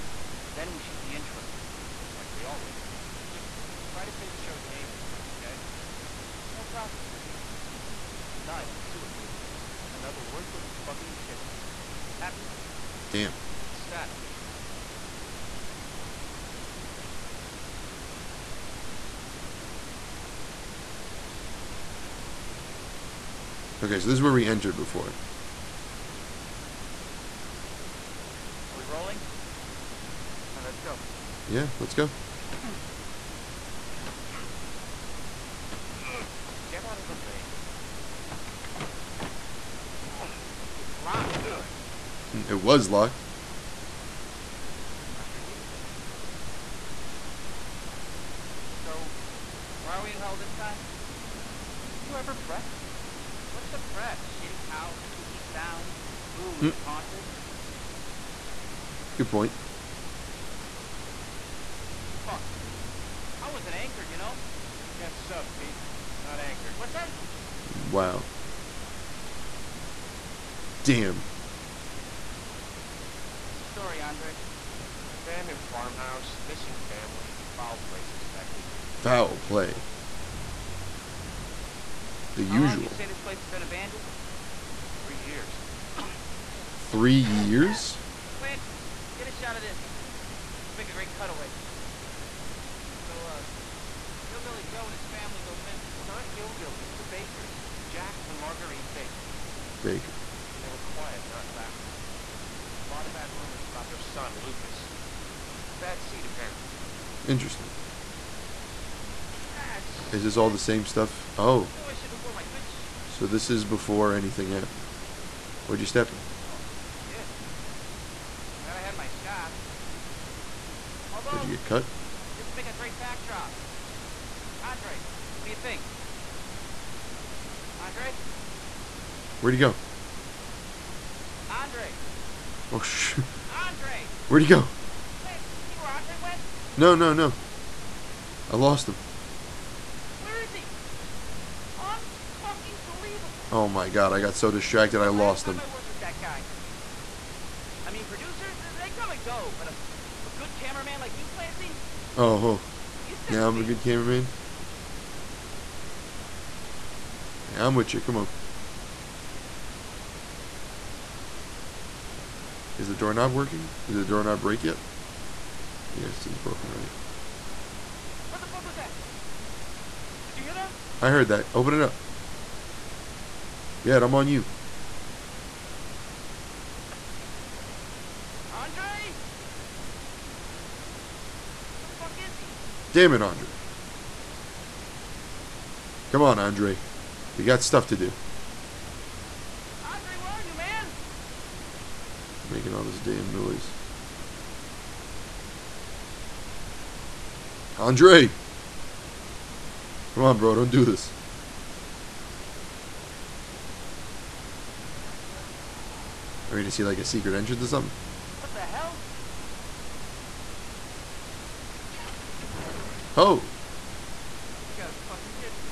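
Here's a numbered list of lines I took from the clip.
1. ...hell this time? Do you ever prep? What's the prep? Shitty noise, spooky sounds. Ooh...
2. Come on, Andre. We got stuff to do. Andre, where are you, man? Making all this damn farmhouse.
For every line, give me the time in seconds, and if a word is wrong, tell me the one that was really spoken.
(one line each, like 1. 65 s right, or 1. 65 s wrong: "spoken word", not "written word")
1. 50 s wrong: "house", not "noise"
2. 186 s wrong: "noise", not "farmhouse".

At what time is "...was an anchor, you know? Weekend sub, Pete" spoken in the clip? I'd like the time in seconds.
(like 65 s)
63 s.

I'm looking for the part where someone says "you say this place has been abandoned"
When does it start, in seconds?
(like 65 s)
82 s.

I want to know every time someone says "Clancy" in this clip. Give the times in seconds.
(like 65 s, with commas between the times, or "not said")
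88 s, 135 s, 151 s.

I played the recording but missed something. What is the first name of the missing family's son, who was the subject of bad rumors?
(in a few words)
Lucas.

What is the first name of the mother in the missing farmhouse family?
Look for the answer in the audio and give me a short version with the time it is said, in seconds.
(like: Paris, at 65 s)
Marguerite, at 98 s.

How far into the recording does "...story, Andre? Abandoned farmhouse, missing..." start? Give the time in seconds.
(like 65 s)
73 s.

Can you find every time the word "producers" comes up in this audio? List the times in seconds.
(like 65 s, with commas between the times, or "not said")
148 s.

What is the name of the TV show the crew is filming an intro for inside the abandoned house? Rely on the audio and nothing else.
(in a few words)
Sewer Gators.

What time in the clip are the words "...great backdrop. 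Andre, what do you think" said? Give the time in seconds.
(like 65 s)
122 s.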